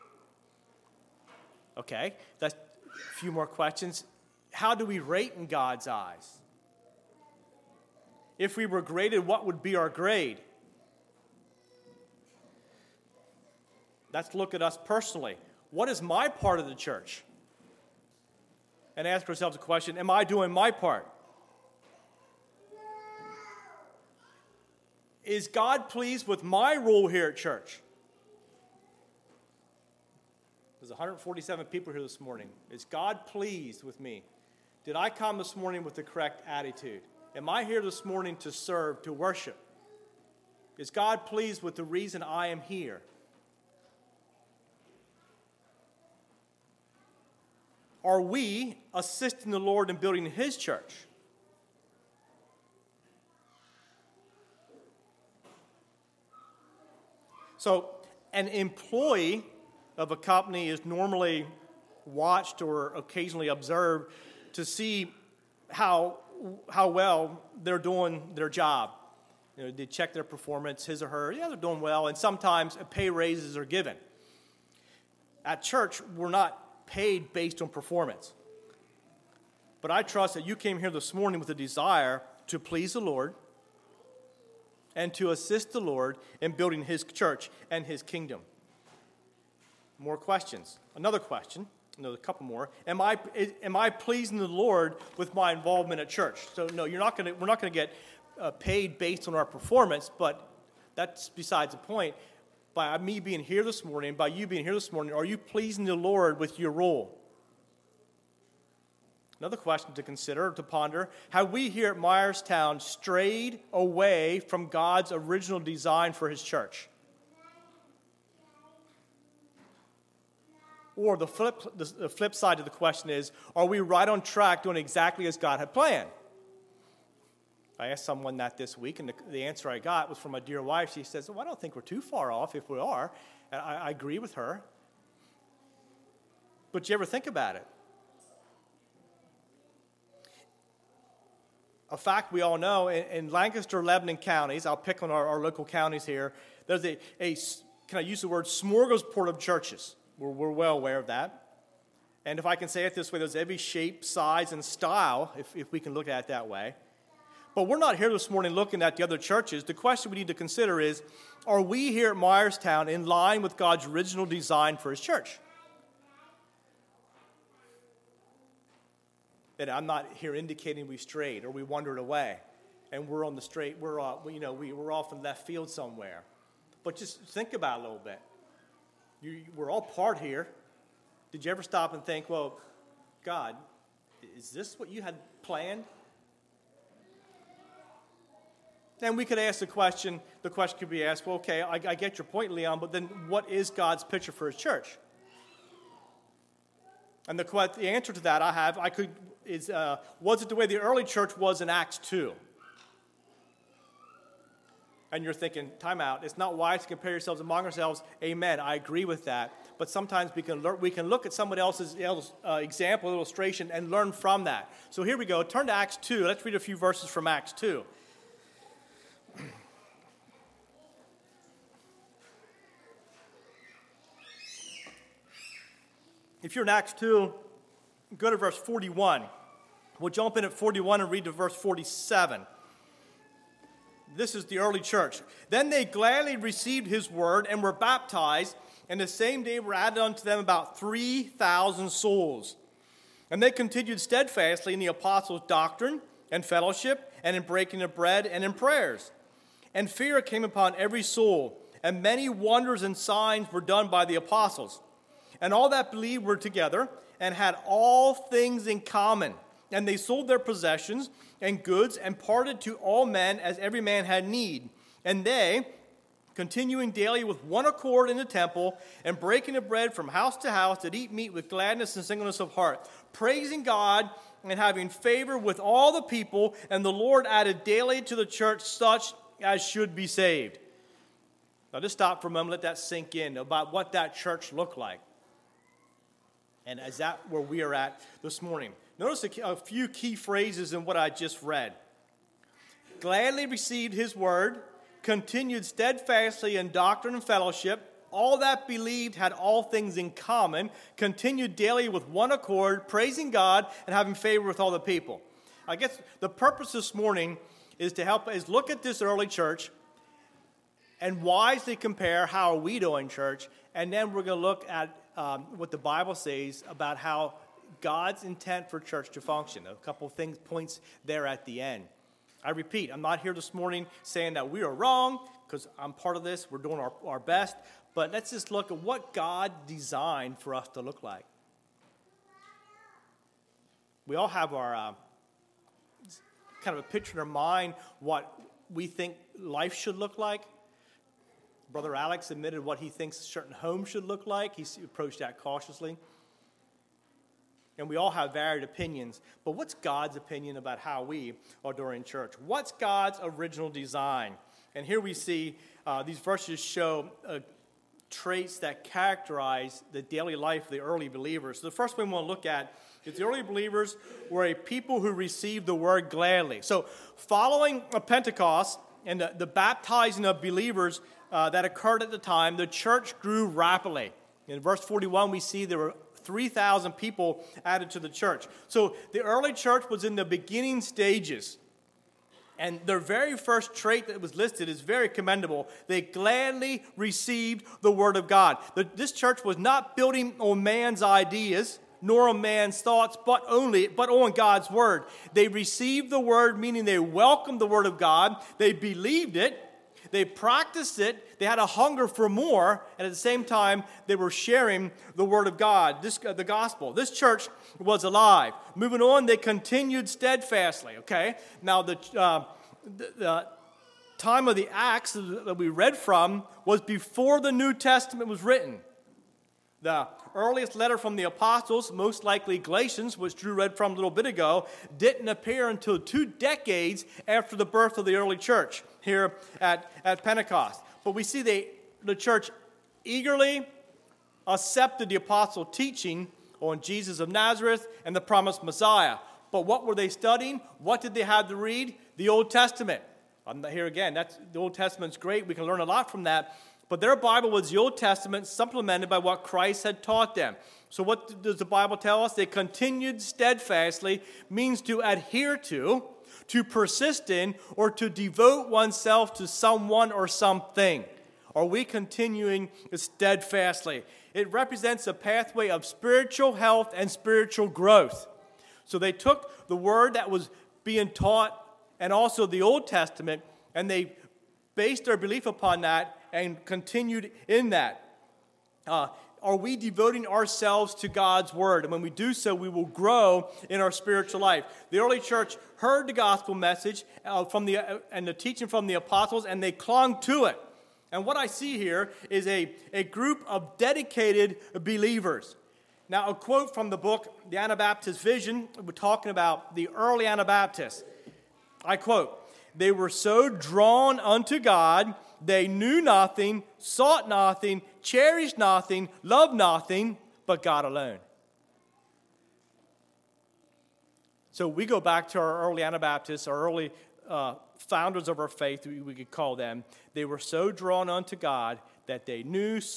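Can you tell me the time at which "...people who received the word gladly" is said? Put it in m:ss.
6:04.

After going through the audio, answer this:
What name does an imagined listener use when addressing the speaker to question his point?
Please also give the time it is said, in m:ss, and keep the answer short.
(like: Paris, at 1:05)
Leon, at 3:12.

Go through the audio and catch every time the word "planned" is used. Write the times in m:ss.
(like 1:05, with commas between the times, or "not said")
2:05, 3:05.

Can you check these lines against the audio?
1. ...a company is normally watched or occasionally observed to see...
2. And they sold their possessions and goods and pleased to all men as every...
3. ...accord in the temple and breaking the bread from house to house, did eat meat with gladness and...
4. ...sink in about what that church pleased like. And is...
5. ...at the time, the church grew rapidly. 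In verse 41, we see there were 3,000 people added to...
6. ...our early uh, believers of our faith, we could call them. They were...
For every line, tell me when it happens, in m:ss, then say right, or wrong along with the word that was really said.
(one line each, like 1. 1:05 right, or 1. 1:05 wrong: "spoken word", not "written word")
1. 1:00 right
2. 4:19 wrong: "parted", not "pleased"
3. 4:27 right
4. 4:42 wrong: "looked", not "pleased"
5. 6:12 right
6. 8:36 wrong: "founders", not "believers".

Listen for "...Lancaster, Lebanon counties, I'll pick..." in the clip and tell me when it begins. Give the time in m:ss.
2:23.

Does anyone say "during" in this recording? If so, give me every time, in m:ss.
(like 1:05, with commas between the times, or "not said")
5:51.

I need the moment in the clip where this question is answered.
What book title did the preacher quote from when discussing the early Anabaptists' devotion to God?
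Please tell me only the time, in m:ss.
8:17.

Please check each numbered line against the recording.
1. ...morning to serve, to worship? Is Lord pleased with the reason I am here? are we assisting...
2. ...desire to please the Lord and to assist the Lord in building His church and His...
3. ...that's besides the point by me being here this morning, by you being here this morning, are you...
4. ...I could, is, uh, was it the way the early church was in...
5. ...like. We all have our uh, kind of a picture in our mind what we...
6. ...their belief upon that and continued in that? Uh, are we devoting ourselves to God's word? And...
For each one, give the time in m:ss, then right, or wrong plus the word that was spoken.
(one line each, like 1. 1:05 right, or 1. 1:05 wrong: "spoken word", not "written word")
1. 0:38 wrong: "God", not "Lord"
2. 1:21 right
3. 1:40 right
4. 3:18 right
5. 5:31 right
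6. 7:55 right.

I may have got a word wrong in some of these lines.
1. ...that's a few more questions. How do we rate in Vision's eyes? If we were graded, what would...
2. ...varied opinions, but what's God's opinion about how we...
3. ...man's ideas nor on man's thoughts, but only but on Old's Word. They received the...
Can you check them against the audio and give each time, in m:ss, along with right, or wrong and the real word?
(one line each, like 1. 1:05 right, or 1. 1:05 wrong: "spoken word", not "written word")
1. 0:02 wrong: "God", not "Vision"
2. 5:48 right
3. 6:30 wrong: "God", not "Old".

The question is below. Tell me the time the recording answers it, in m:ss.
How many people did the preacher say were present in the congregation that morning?
0:30.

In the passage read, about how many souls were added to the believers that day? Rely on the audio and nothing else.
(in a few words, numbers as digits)
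3,000.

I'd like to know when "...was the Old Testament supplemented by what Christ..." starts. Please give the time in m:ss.
7:27.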